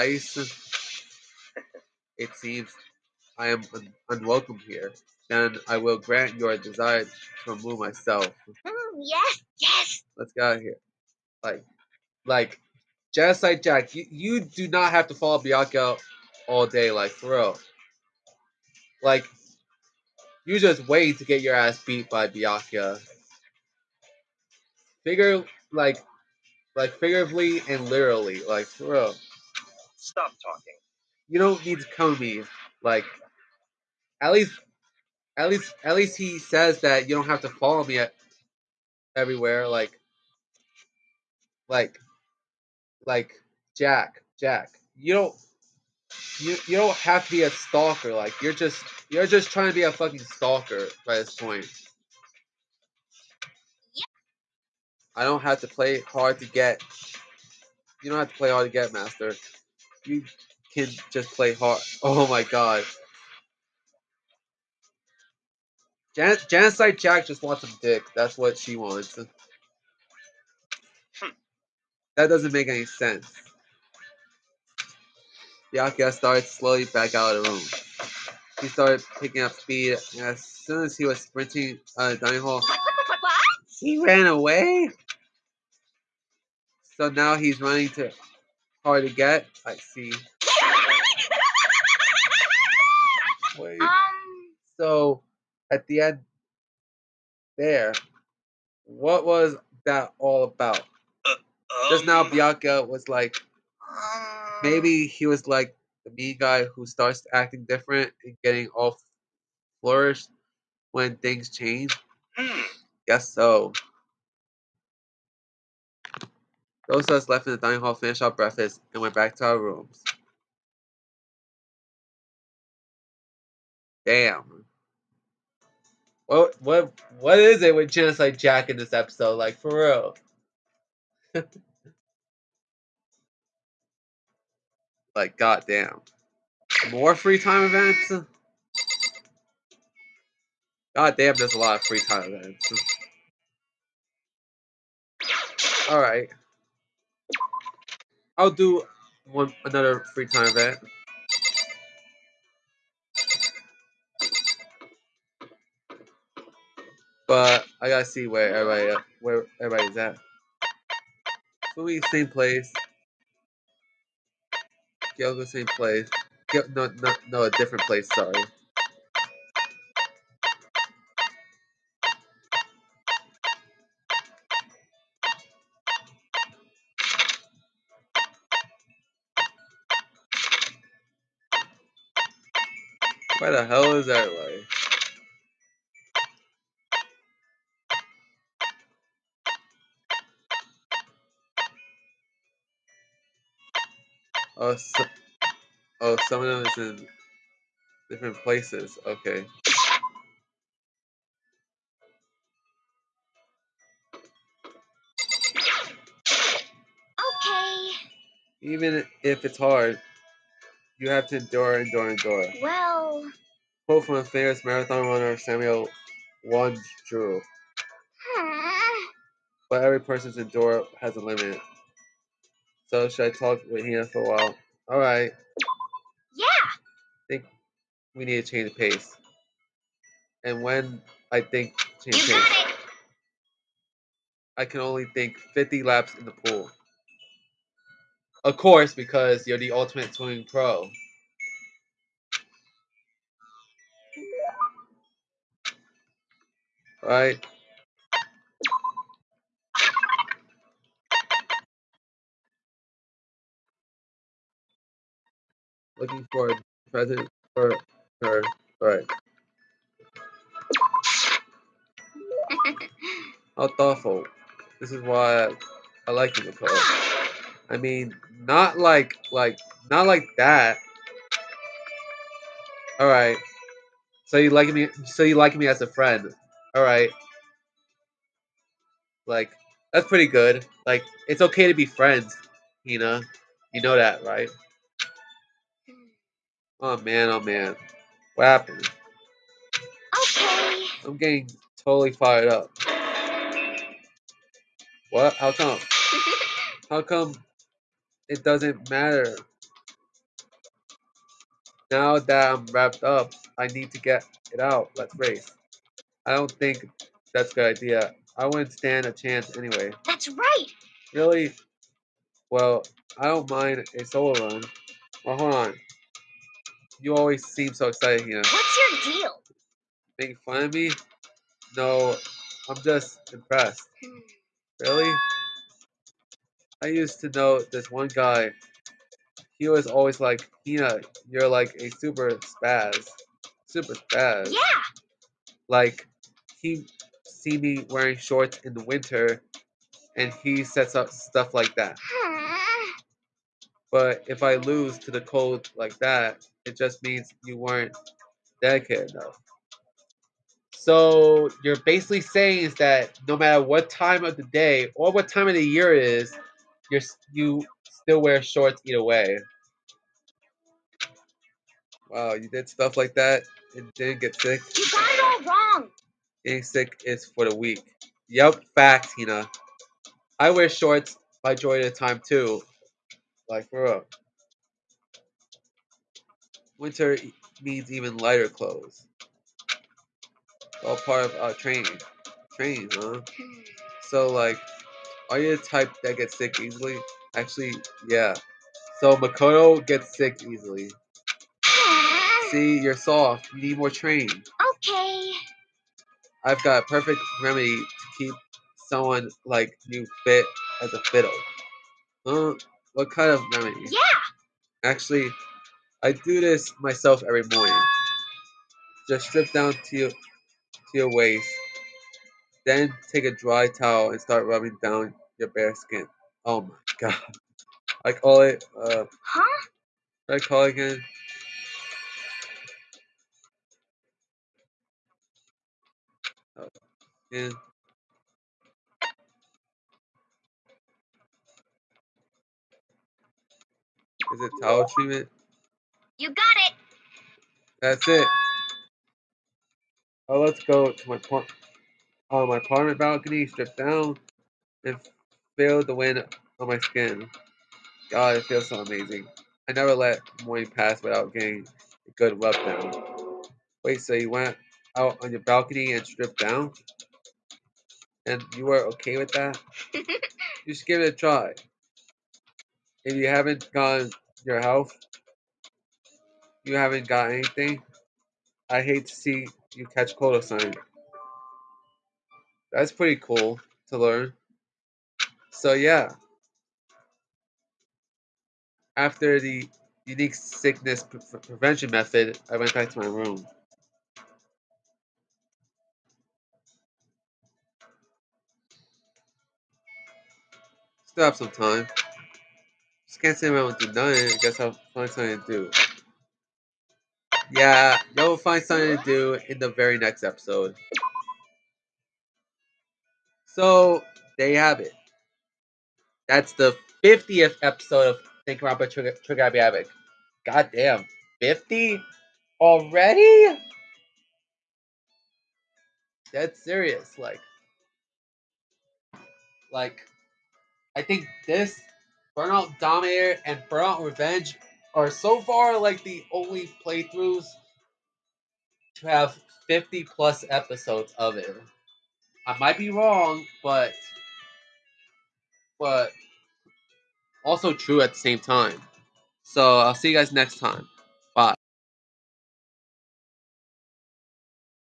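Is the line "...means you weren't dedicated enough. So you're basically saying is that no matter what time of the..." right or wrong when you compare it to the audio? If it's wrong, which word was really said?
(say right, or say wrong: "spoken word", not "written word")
right.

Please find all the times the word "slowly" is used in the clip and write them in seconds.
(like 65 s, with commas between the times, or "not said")
76 s.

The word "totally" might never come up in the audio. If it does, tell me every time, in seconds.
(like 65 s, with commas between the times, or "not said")
291 s.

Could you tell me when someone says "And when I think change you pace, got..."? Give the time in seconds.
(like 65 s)
230 s.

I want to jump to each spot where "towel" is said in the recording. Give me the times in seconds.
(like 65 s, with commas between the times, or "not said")
413 s, 434 s.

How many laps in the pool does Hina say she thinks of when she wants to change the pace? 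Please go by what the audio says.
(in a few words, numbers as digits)
50.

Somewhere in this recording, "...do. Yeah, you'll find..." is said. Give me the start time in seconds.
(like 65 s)
495 s.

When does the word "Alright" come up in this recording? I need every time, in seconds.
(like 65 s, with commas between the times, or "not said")
145 s.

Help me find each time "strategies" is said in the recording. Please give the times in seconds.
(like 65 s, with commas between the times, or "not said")
not said.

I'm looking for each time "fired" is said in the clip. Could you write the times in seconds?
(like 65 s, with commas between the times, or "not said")
292 s.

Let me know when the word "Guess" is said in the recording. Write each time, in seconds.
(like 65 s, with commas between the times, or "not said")
113 s, 494 s.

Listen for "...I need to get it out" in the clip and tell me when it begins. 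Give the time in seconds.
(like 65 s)
303 s.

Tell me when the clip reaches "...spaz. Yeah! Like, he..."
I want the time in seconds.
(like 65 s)
333 s.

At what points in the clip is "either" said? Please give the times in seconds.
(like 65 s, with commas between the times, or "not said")
358 s.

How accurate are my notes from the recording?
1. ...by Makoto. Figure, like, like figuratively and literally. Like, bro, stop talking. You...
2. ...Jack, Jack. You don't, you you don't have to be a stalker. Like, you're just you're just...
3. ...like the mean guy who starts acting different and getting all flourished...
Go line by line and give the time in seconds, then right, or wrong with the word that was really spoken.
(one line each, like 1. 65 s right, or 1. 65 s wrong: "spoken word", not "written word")
1. 22 s wrong: "Byakuya", not "Makoto"
2. 43 s right
3. 105 s right.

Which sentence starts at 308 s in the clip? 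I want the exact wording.
I wouldn't stand a chance anyway.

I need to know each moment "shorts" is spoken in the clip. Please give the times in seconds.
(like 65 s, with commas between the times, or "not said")
338 s, 358 s, 370 s.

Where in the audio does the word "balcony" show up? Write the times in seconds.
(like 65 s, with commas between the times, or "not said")
442 s, 455 s.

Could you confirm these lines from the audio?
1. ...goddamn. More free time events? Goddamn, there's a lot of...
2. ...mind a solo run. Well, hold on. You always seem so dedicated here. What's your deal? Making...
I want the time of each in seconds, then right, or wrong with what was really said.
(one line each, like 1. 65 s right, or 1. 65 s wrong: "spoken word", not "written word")
1. 135 s right
2. 313 s wrong: "excited", not "dedicated".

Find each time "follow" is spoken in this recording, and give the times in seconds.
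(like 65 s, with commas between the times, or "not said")
15 s, 37 s.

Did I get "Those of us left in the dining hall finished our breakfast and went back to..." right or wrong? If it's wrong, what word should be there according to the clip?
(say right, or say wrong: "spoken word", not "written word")
right.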